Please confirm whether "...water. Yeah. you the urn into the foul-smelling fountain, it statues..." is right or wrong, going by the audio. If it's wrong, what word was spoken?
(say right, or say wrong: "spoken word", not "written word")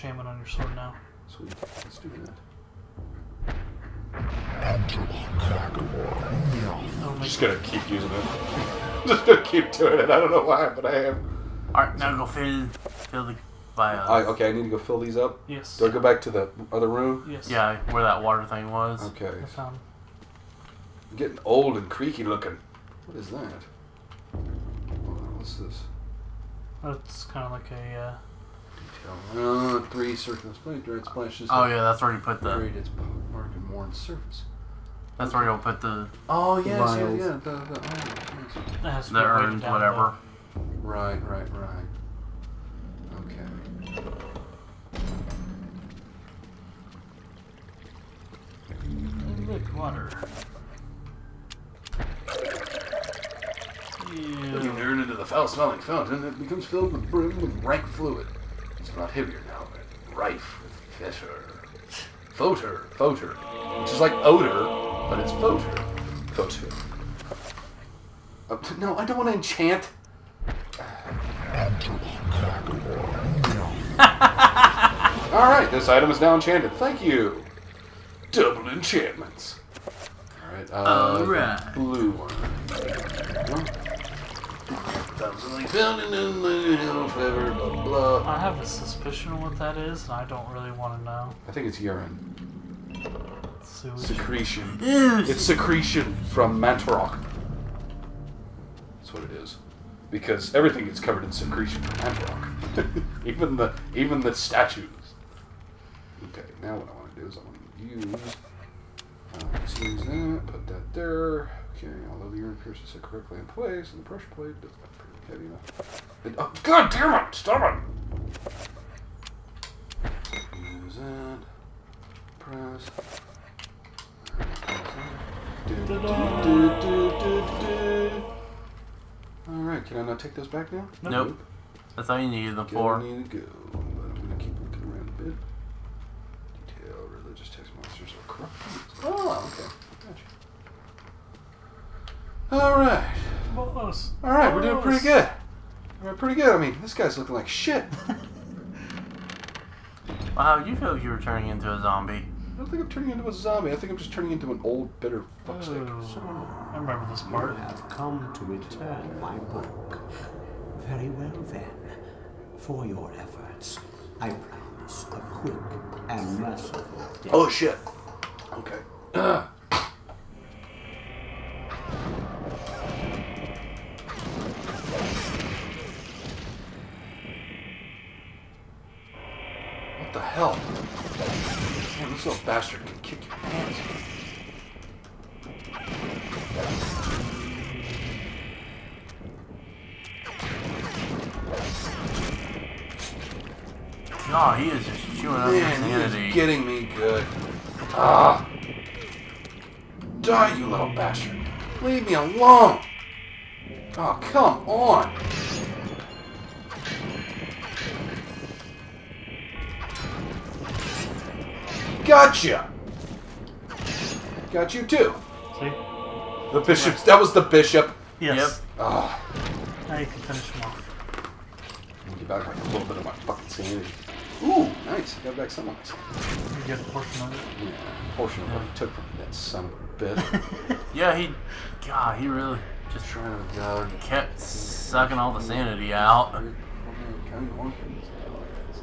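wrong: "becomes", not "statues".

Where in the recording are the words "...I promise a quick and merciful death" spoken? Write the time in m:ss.
2:44.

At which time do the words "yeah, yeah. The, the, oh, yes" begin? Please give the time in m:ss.
0:37.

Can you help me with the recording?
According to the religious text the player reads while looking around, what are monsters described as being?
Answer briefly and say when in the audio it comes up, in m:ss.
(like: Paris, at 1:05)
corrupt, at 2:17.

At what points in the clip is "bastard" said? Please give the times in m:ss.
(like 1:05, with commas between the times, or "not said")
3:02, 3:20.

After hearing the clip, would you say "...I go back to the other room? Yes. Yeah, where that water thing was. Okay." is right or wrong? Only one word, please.
right.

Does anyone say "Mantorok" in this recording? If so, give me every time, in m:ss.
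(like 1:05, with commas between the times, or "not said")
1:36, 1:41.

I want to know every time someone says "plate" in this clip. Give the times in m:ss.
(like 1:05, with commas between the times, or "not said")
0:30, 1:54.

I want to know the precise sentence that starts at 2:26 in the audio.
I mean, this guy's looking like shit.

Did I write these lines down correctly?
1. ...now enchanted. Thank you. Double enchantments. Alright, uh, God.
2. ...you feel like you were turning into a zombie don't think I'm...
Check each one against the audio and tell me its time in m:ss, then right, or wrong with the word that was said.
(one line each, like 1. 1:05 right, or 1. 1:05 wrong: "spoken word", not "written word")
1. 1:16 wrong: "Alright", not "God"
2. 2:30 right.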